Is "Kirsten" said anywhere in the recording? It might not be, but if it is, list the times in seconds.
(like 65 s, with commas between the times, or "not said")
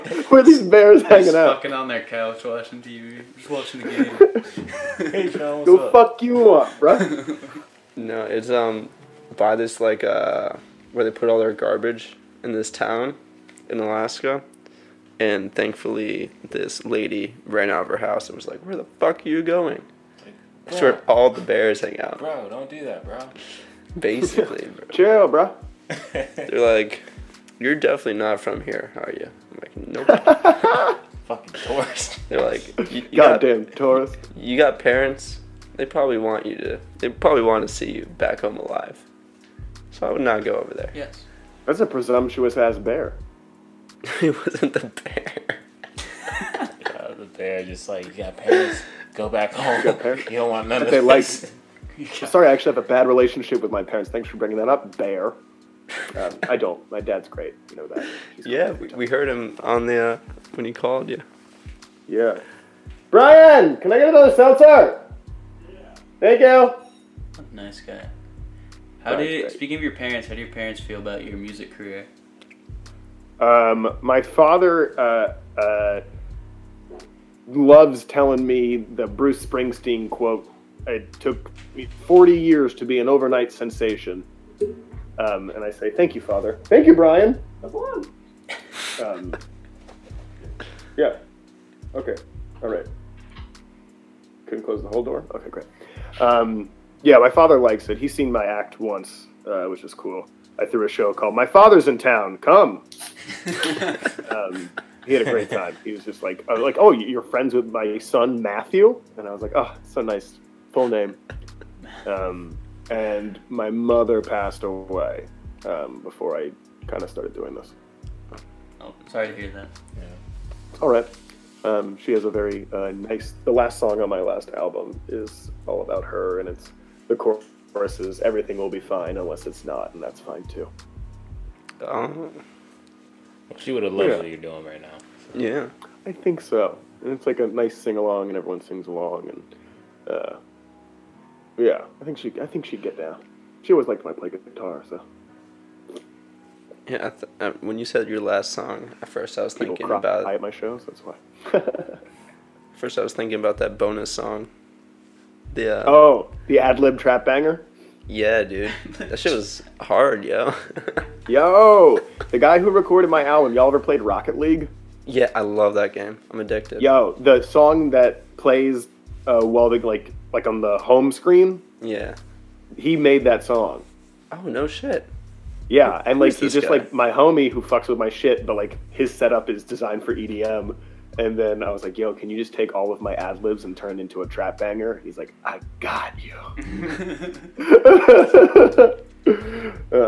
not said.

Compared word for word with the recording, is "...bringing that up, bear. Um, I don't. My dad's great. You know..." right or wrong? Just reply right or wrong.
right.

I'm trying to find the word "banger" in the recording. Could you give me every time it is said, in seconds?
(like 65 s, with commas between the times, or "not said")
157 s, 184 s.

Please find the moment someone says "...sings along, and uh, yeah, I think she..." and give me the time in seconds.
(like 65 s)
138 s.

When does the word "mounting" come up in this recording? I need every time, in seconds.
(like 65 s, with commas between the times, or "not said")
not said.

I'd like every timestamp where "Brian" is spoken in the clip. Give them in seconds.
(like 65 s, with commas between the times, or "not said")
63 s, 86 s.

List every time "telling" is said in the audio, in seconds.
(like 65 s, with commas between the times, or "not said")
78 s.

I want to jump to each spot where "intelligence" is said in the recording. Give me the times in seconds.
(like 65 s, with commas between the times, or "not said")
not said.